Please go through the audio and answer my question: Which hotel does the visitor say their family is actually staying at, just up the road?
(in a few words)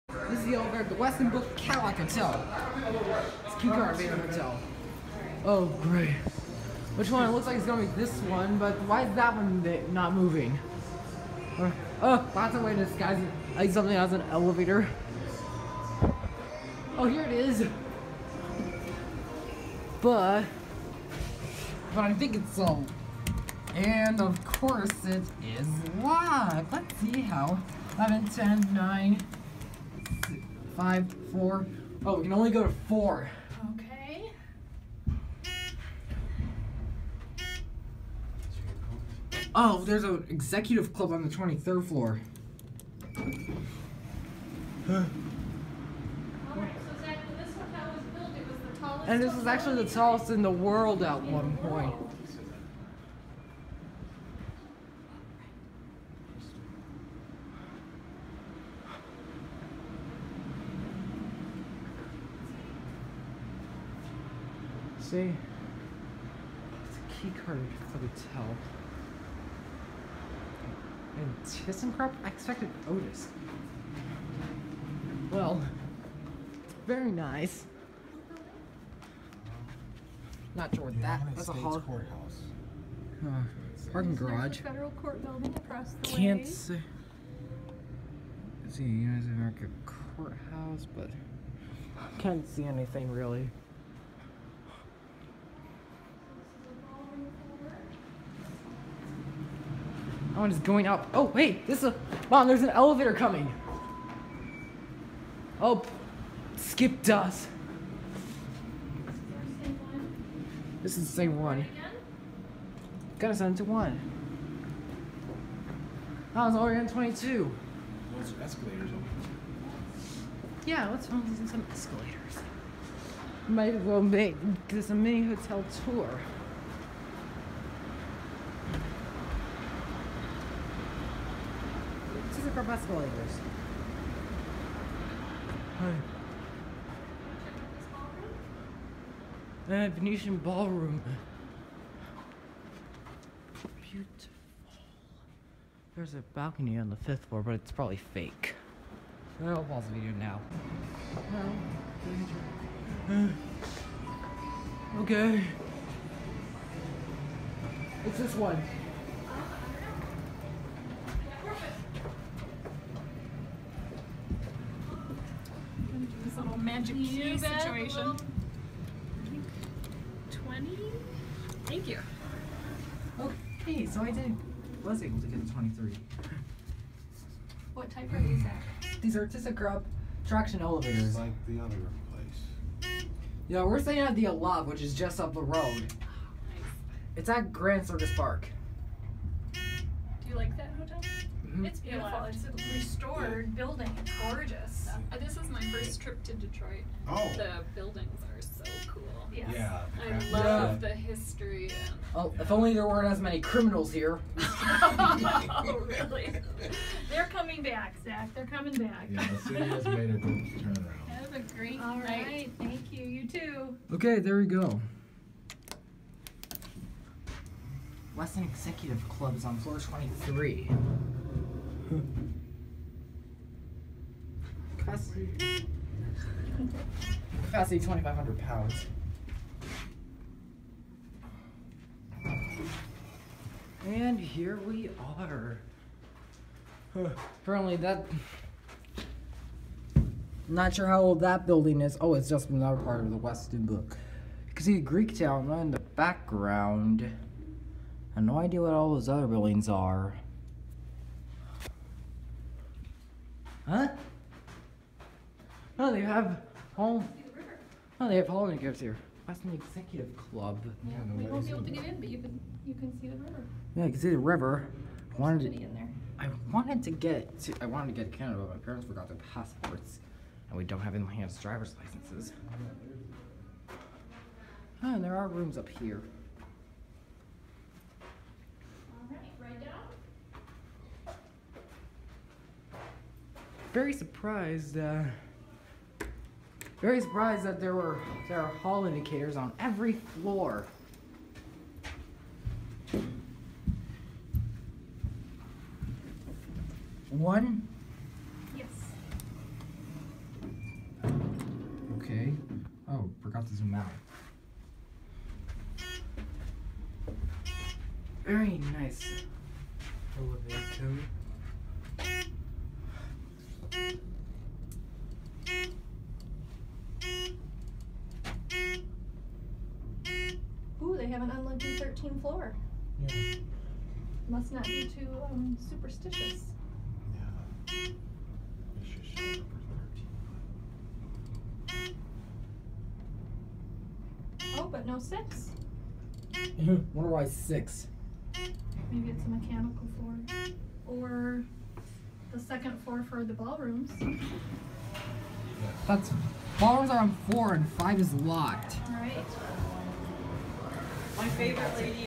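Aloft.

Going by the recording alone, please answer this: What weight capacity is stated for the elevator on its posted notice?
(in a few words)
2,500 pounds.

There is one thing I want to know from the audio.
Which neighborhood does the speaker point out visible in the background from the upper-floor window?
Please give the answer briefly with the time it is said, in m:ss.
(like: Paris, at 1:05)
Greek town, at 4:04.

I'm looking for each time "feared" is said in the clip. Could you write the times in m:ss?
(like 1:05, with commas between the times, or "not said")
not said.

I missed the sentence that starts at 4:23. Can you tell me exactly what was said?
Yeah, you can see the river.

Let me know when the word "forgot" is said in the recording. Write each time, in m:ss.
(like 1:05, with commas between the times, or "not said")
4:28, 5:03.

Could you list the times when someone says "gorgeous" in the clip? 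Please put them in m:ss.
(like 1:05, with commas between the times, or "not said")
3:14.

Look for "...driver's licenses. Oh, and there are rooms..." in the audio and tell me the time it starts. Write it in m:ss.
4:31.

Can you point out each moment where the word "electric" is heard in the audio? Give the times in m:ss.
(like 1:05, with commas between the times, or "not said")
2:12.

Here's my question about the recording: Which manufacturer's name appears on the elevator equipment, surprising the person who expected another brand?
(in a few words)
ThyssenKrupp.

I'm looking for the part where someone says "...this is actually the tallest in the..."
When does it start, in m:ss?
0:49.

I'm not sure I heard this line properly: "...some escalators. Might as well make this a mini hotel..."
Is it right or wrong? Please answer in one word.
right.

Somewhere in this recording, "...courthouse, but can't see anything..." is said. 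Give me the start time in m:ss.
1:30.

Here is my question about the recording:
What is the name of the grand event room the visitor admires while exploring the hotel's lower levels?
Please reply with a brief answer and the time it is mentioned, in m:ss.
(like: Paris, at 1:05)
Venetian ballroom, at 2:19.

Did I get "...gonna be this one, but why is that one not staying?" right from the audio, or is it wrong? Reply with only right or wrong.
wrong.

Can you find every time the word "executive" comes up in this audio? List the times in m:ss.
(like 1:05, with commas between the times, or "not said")
0:40, 3:38, 4:19.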